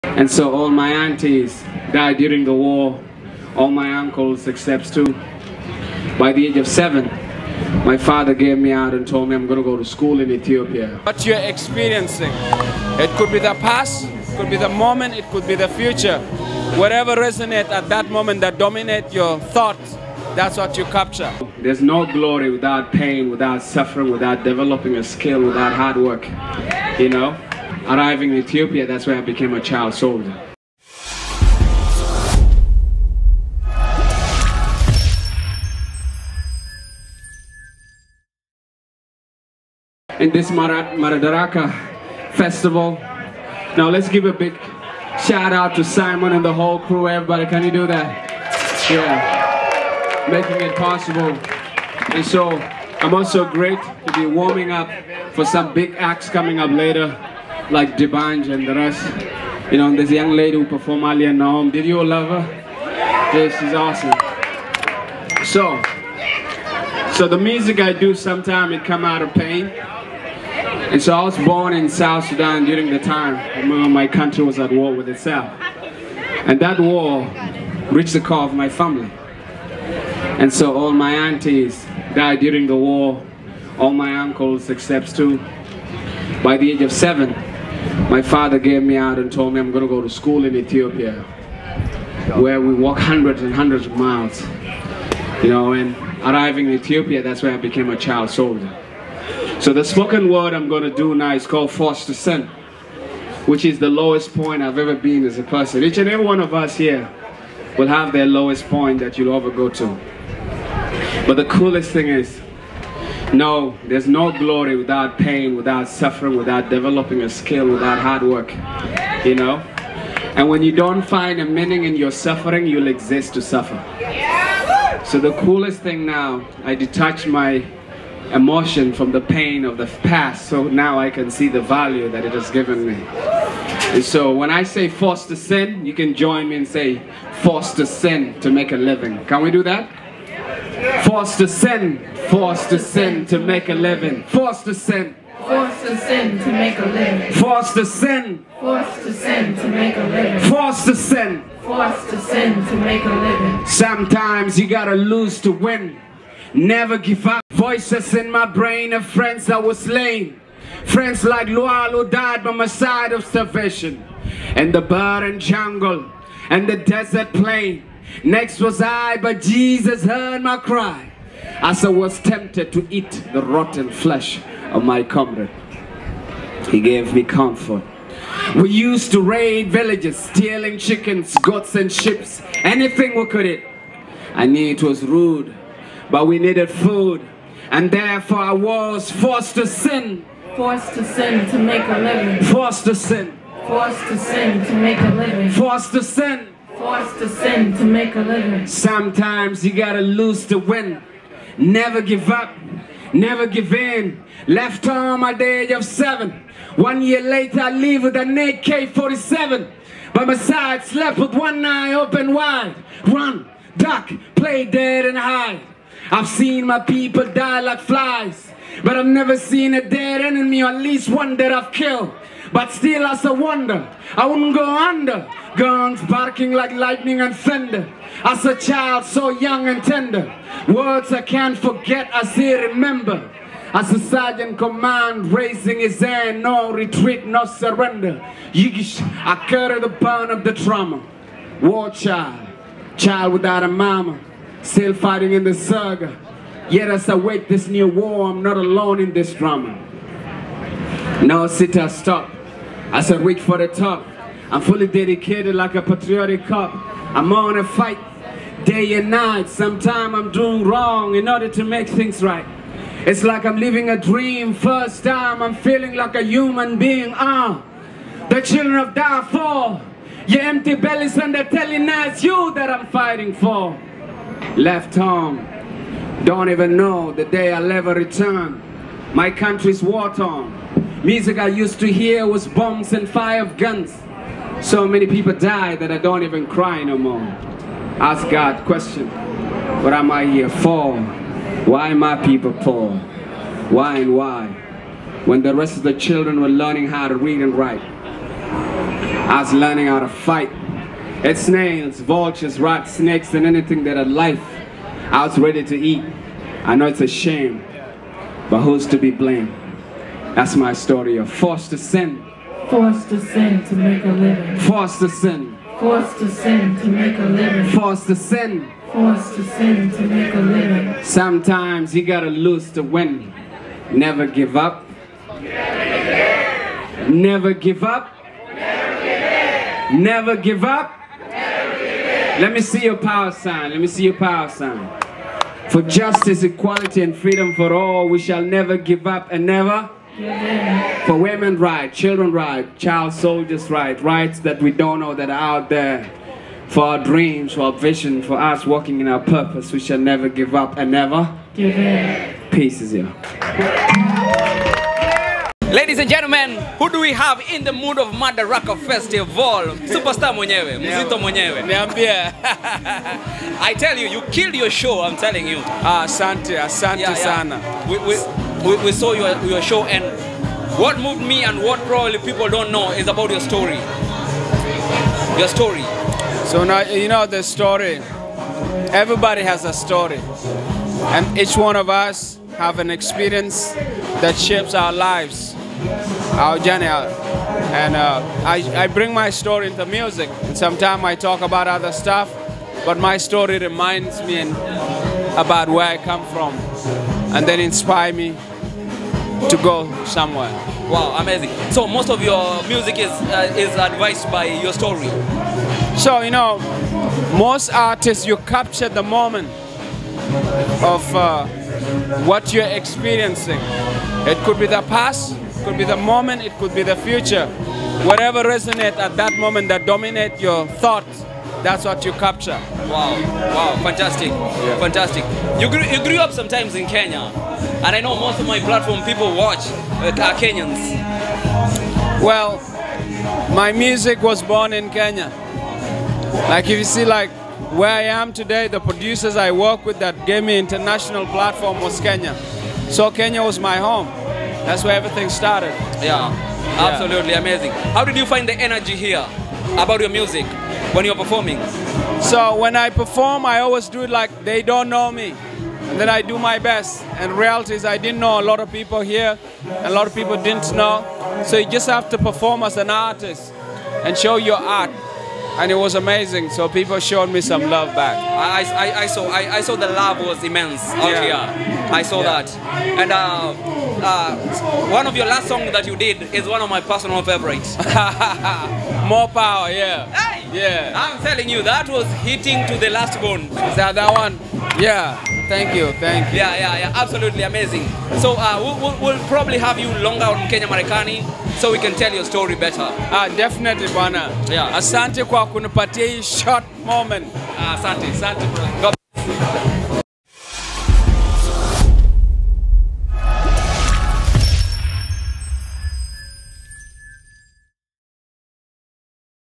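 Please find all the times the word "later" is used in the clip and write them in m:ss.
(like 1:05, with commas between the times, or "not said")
0:56, 3:27.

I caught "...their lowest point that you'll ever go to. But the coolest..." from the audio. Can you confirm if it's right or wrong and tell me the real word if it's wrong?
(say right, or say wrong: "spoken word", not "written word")
right.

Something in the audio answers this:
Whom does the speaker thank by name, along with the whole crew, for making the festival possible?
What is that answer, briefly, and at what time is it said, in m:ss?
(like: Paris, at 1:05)
Simon, at 0:45.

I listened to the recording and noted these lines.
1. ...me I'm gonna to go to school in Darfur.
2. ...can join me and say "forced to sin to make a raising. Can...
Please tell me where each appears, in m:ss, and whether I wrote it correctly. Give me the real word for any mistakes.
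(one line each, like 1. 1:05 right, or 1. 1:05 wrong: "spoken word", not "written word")
1. 0:09 wrong: "Ethiopia", not "Darfur"
2. 2:15 wrong: "living", not "raising".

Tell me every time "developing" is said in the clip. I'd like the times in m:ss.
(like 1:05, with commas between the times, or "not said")
0:24, 1:56.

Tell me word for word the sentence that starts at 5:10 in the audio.
That's my story of forced to sin.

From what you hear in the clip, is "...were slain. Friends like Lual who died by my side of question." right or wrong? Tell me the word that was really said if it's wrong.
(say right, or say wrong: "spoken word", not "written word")
wrong: "starvation", not "question".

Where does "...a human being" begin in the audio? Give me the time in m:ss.
4:26.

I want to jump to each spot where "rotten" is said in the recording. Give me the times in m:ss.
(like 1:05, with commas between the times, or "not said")
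2:53.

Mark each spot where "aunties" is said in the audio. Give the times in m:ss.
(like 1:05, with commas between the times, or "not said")
0:00, 1:21.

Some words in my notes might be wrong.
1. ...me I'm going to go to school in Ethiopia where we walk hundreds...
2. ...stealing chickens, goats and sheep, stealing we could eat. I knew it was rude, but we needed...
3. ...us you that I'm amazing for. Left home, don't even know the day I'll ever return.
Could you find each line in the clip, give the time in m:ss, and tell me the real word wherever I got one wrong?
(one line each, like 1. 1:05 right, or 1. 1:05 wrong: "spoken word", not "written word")
1. 1:29 right
2. 3:00 wrong: "anything", not "stealing"
3. 4:31 wrong: "fighting", not "amazing".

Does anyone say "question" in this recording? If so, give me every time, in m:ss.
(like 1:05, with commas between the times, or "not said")
4:48.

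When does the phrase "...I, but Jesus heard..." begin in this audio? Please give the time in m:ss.
2:48.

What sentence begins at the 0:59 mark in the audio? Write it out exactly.
You know, there's a young lady who performed earlier, Naom.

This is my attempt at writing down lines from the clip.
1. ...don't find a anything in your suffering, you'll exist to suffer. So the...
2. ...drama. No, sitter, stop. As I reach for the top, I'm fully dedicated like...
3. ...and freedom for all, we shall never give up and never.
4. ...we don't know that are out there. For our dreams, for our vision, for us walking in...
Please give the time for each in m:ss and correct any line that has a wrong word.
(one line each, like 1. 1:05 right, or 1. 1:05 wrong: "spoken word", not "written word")
1. 2:00 wrong: "meaning", not "anything"
2. 4:09 right
3. 5:37 right
4. 5:44 right.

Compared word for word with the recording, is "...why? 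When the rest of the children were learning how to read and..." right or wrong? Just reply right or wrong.
right.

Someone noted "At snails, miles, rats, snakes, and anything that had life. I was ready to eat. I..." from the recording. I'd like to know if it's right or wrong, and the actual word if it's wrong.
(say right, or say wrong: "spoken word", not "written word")
wrong: "vultures", not "miles".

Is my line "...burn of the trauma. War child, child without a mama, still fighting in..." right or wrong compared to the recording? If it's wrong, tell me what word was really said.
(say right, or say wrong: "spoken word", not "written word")
right.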